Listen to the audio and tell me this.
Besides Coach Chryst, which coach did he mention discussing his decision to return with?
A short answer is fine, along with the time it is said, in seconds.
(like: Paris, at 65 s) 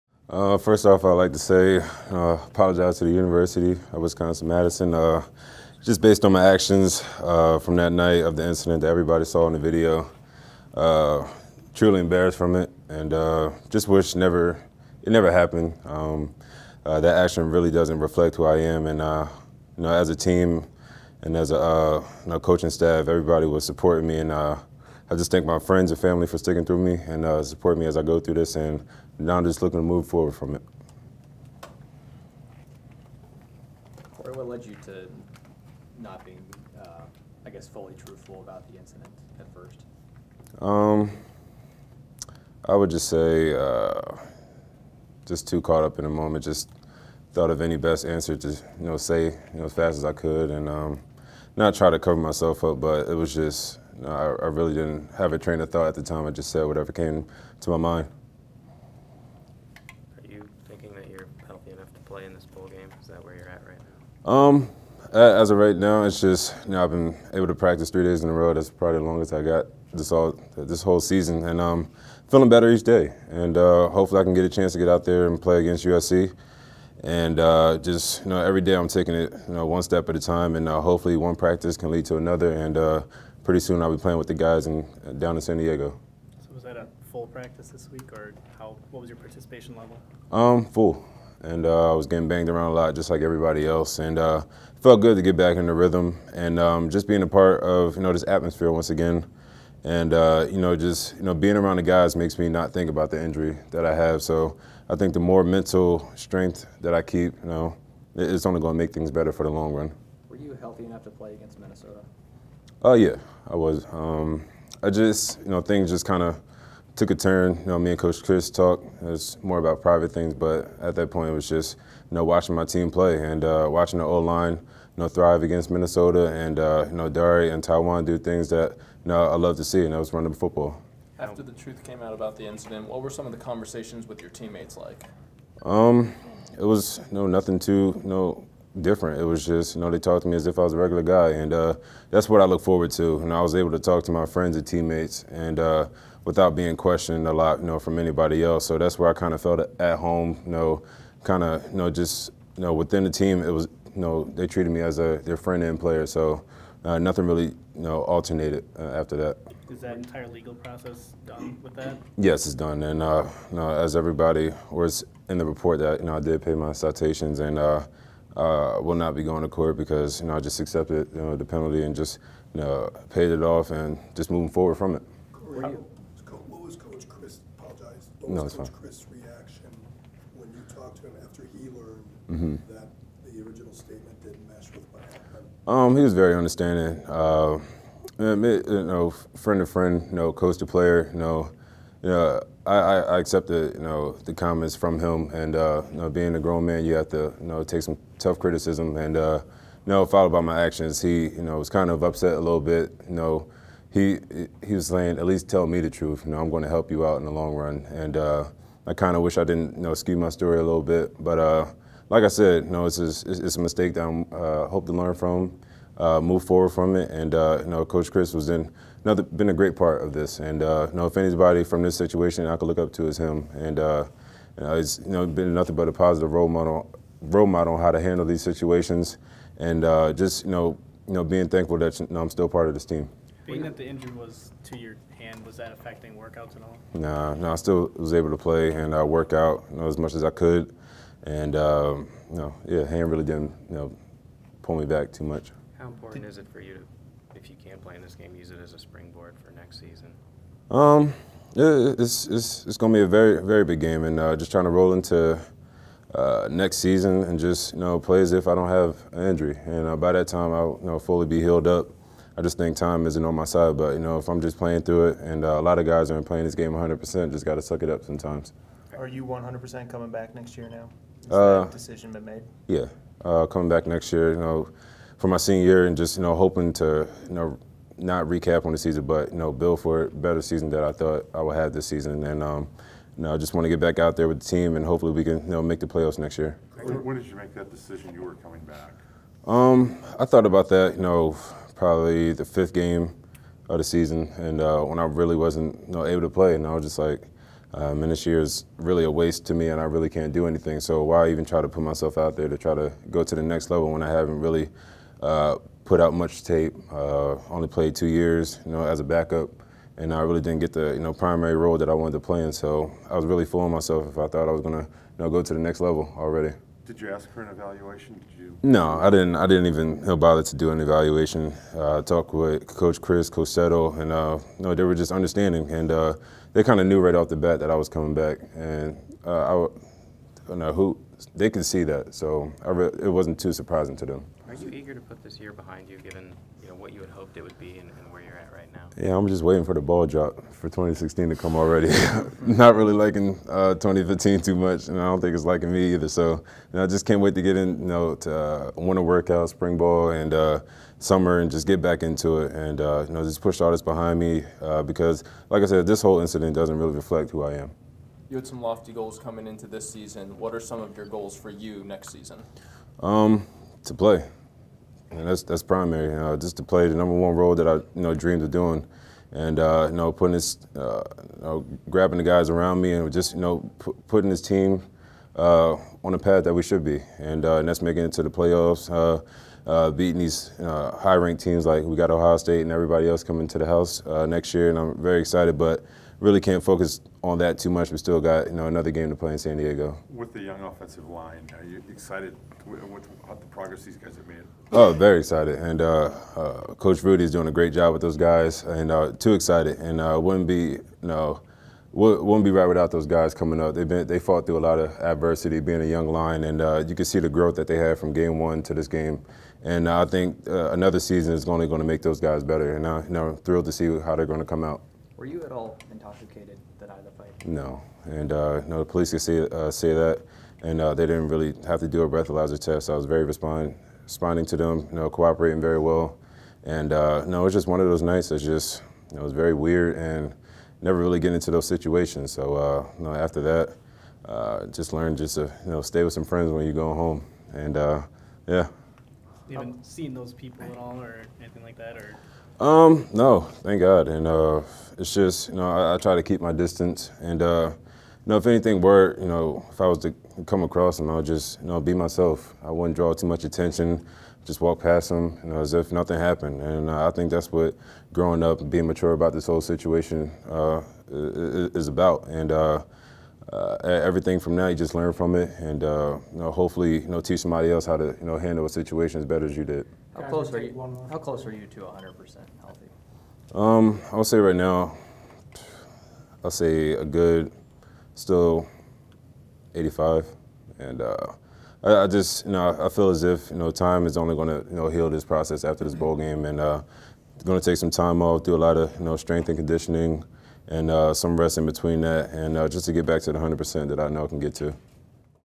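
Coach Settle, at 323 s.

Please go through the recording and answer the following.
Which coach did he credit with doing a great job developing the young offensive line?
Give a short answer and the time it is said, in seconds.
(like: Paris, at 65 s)
Coach Rudy, at 396 s.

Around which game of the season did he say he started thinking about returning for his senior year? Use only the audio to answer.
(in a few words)
fifth game.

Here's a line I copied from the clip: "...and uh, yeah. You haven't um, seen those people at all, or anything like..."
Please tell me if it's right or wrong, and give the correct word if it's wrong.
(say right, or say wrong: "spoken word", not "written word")
right.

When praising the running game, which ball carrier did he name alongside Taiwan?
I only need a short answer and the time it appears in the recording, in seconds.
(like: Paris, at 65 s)
Dari, at 127 s.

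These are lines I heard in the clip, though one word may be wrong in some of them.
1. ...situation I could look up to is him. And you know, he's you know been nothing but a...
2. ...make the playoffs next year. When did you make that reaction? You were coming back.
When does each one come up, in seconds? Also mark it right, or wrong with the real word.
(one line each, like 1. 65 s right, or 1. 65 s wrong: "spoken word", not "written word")
1. 221 s right
2. 285 s wrong: "decision", not "reaction".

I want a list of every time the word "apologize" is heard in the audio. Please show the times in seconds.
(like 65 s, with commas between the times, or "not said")
2 s, 177 s.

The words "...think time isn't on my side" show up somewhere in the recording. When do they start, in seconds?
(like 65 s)
262 s.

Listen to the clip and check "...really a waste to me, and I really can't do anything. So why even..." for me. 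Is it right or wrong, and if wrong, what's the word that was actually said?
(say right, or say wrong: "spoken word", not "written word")
right.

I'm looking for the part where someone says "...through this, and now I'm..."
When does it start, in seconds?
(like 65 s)
28 s.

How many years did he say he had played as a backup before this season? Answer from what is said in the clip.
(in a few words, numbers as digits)
2 years.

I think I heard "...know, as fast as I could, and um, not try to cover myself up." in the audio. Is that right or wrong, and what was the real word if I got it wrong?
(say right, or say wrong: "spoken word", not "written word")
right.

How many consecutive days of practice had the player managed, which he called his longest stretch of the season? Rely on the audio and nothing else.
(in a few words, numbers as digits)
3 days.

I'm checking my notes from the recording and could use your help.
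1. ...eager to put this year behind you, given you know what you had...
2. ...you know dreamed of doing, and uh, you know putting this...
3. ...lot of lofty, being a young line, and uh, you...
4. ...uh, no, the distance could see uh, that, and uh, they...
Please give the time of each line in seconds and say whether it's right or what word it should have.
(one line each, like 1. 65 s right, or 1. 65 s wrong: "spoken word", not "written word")
1. 334 s right
2. 367 s right
3. 404 s wrong: "adversity", not "lofty"
4. 418 s wrong: "police", not "distance".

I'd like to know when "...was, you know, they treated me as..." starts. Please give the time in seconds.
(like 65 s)
153 s.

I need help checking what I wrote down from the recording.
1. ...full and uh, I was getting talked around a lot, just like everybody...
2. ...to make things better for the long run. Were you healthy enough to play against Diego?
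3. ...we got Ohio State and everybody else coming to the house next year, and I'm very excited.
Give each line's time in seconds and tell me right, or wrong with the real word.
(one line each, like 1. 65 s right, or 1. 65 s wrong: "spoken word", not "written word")
1. 90 s wrong: "banged", not "talked"
2. 108 s wrong: "Minnesota", not "Diego"
3. 381 s right.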